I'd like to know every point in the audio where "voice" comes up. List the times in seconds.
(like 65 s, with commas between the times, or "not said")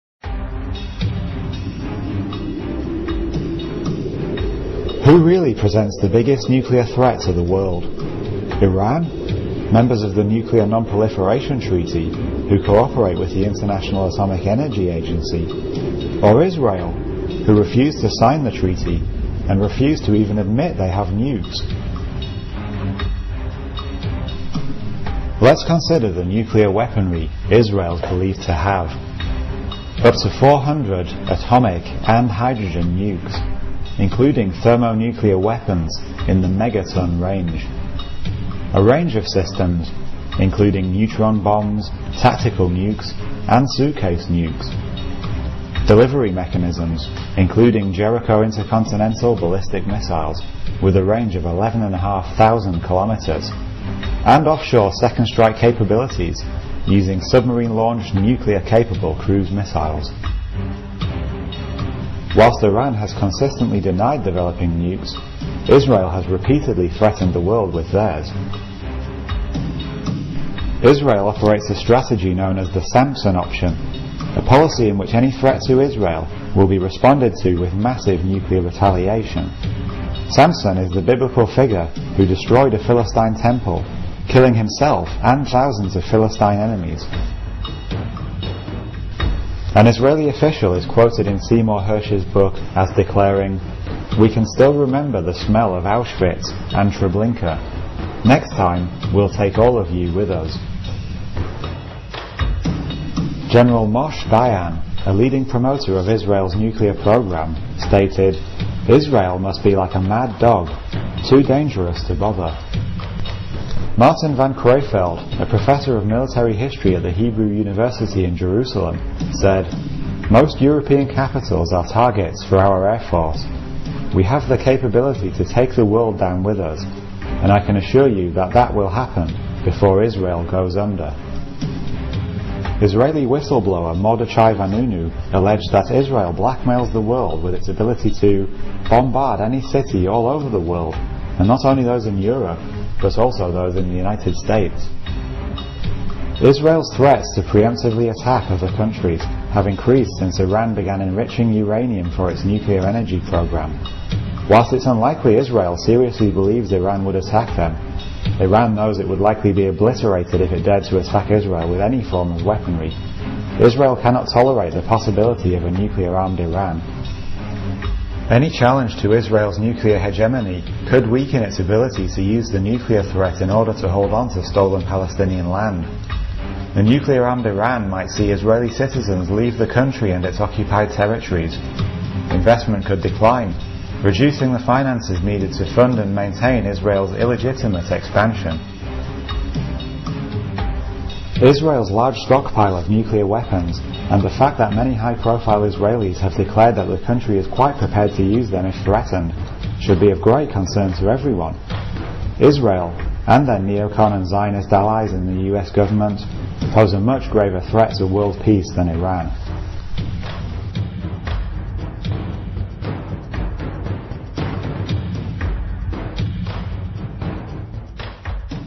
not said.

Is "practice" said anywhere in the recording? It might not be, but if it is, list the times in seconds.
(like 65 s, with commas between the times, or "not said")
not said.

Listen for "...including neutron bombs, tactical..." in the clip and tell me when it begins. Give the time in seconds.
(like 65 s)
40 s.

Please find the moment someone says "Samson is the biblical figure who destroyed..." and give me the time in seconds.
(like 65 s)
80 s.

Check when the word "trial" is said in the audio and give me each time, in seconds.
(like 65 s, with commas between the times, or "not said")
not said.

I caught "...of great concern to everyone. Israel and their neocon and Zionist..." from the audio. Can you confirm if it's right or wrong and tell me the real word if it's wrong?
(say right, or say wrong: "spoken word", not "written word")
right.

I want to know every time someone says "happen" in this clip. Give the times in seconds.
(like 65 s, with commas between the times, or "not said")
128 s.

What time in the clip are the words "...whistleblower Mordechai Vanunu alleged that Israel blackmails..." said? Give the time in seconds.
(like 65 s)
133 s.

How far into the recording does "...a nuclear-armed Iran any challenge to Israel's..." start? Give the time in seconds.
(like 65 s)
165 s.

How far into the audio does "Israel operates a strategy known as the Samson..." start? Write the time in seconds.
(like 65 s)
70 s.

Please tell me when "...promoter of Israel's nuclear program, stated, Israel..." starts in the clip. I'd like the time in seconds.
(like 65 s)
105 s.